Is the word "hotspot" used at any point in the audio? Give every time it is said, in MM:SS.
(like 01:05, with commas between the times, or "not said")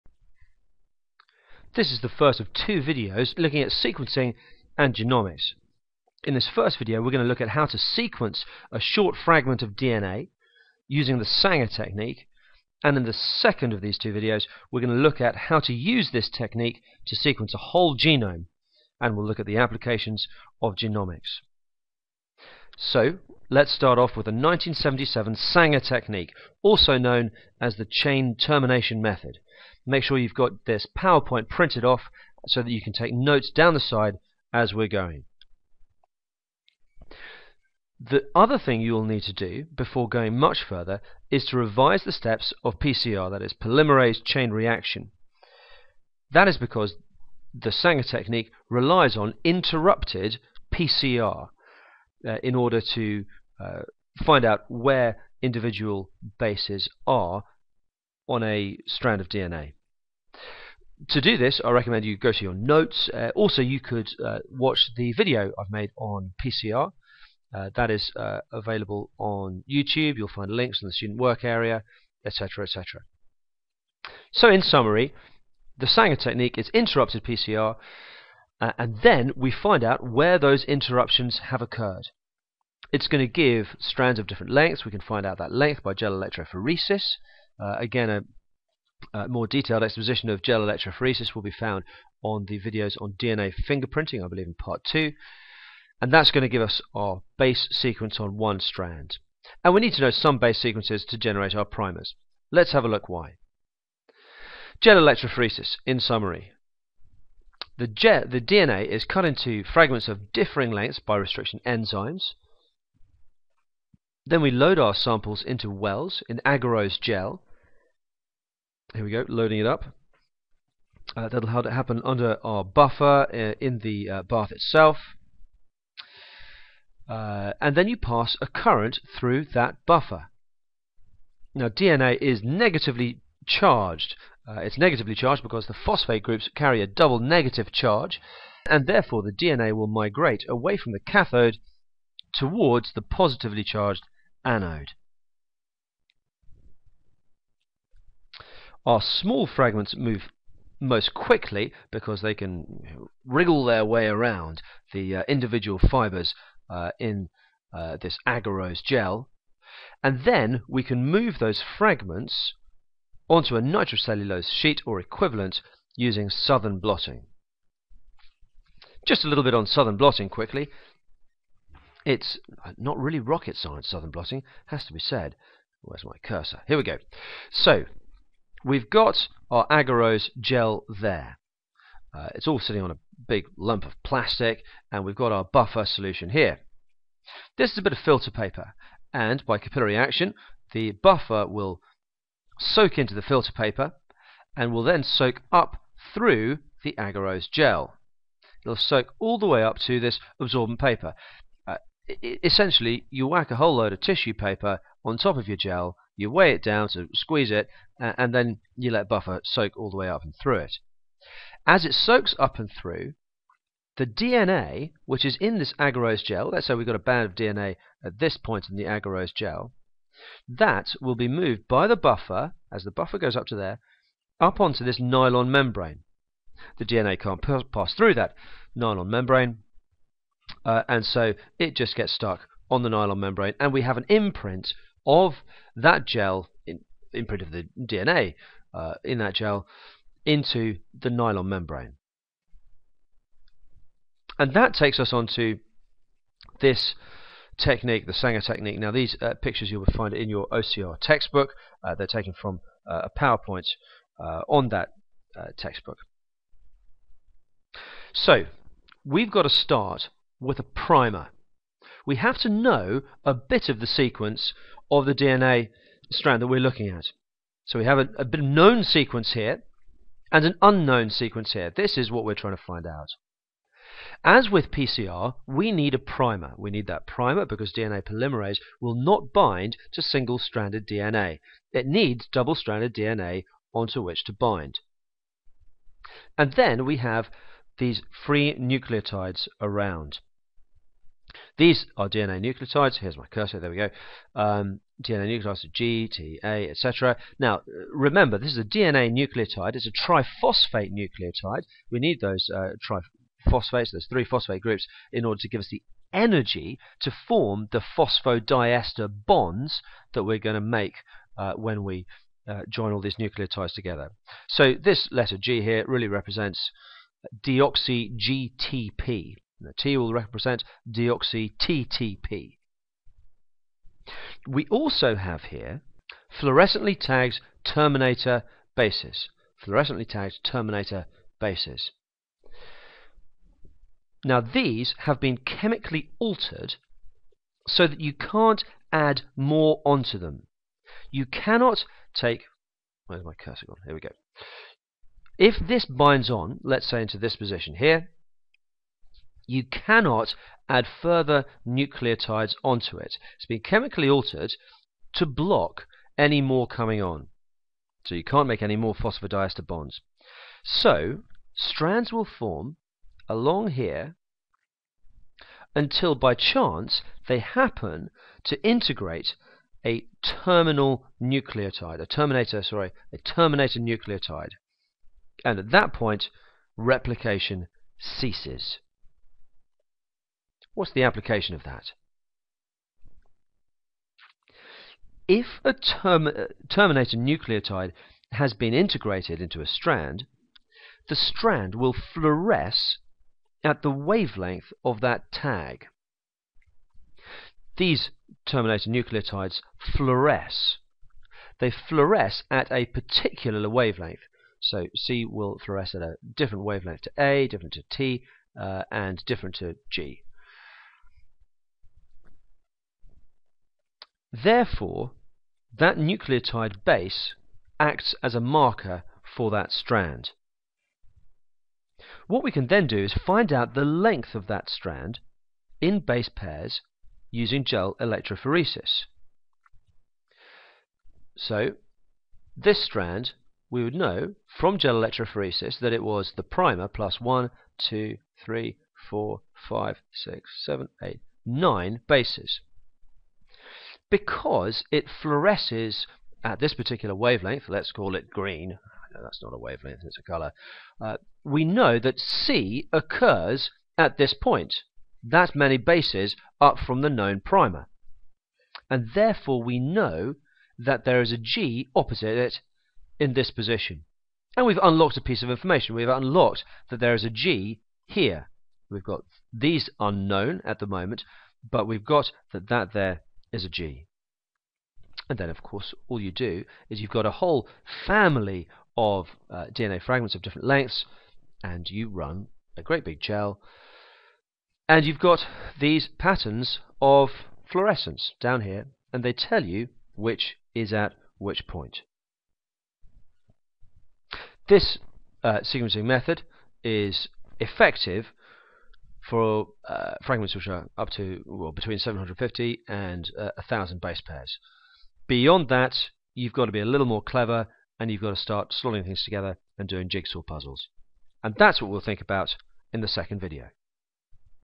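not said.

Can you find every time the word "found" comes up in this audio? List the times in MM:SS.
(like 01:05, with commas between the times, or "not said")
01:31.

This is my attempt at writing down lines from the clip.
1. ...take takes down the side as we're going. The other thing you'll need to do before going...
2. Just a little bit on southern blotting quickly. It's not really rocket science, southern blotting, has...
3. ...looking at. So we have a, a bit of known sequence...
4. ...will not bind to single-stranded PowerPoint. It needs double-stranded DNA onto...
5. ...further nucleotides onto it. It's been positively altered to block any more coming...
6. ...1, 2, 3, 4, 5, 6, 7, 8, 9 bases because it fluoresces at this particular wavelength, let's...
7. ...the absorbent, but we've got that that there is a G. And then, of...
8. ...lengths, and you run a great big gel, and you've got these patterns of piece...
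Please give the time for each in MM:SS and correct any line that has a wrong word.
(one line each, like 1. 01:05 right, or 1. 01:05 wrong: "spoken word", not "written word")
1. 00:32 wrong: "notes", not "takes"
2. 02:49 right
3. 04:26 right
4. 04:38 wrong: "DNA", not "PowerPoint"
5. 05:50 wrong: "chemically", not "positively"
6. 07:17 right
7. 07:50 wrong: "moment", not "absorbent"
8. 08:00 wrong: "fluorescence", not "piece".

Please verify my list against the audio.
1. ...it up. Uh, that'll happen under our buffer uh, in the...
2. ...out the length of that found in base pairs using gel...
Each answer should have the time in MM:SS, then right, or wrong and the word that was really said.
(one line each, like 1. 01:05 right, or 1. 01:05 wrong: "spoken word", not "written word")
1. 01:59 right
2. 07:03 wrong: "strand", not "found".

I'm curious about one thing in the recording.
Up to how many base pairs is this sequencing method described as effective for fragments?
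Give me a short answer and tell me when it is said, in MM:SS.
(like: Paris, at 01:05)
1,000, at 08:23.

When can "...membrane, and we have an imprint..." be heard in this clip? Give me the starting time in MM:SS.
03:53.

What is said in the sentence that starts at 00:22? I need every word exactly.
So let's start off with the 1977 Sanger technique also known as the chain termination method.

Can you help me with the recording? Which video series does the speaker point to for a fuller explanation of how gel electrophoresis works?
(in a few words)
DNA fingerprinting.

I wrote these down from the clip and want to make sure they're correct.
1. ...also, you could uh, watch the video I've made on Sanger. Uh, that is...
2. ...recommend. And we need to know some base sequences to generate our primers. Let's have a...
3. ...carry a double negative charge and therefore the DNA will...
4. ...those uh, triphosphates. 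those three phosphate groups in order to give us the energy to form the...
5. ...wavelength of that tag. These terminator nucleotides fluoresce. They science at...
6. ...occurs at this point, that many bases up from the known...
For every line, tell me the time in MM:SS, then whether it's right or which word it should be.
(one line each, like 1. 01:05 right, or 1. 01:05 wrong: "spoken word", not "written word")
1. 01:03 wrong: "PCR", not "Sanger"
2. 01:38 wrong: "strand", not "recommend"
3. 02:16 right
4. 05:02 right
5. 06:33 wrong: "fluoresce", not "science"
6. 07:32 right.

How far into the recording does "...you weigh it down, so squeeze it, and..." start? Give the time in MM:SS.
03:26.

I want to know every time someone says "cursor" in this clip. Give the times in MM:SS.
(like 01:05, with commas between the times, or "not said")
02:56, 04:53, 05:43.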